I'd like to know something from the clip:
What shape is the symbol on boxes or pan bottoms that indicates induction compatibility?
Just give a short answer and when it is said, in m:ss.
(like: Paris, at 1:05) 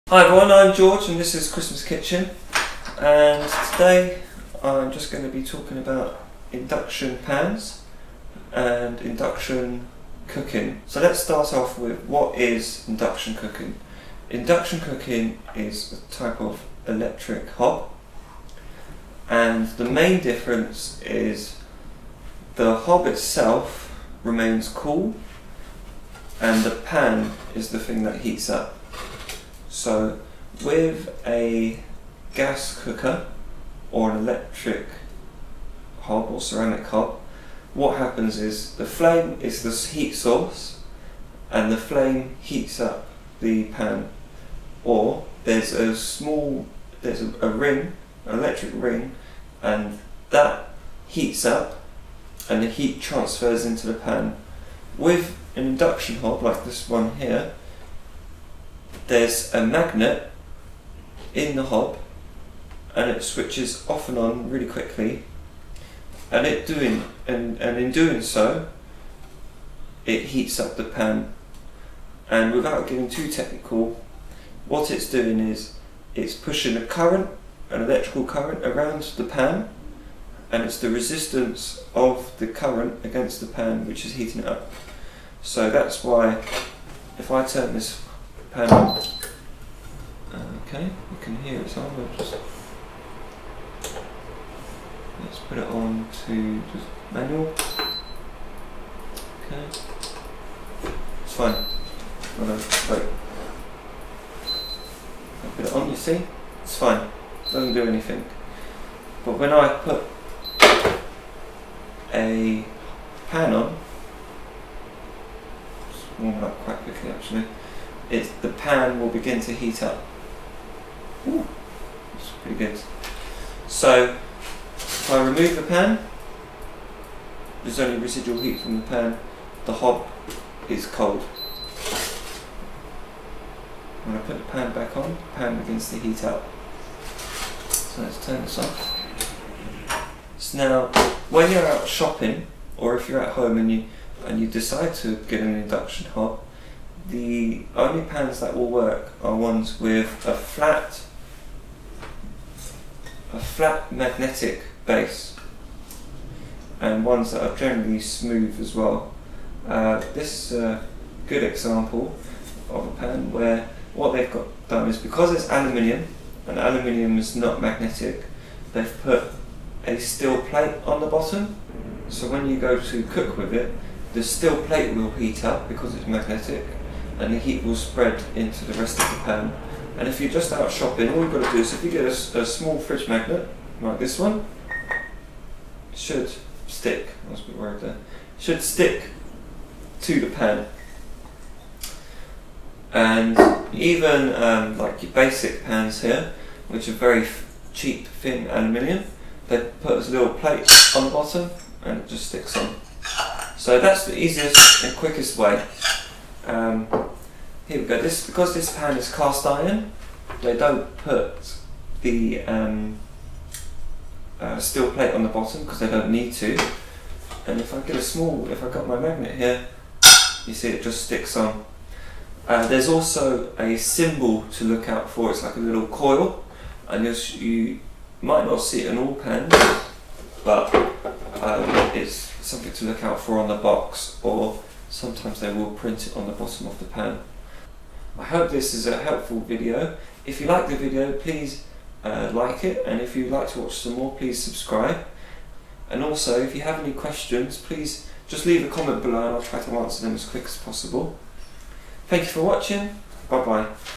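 a little coil, at 3:45.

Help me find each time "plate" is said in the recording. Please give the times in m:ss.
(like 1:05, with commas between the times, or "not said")
2:50, 2:54, 3:20, 3:34.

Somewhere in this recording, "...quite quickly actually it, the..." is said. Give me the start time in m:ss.
1:56.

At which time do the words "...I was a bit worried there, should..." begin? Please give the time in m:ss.
3:07.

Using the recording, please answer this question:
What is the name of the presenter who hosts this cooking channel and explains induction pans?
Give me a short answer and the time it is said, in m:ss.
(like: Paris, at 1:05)
George, at 0:00.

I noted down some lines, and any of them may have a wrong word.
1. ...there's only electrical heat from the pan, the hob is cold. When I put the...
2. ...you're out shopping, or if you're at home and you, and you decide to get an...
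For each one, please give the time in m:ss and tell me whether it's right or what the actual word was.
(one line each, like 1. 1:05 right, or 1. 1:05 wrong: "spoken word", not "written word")
1. 2:07 wrong: "residual", not "electrical"
2. 2:21 right.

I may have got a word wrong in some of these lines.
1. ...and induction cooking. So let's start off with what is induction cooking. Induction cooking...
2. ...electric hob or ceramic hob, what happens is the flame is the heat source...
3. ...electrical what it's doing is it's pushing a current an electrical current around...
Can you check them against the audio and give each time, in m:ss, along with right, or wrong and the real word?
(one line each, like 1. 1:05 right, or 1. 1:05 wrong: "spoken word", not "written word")
1. 0:08 right
2. 0:34 right
3. 1:13 wrong: "technical", not "electrical".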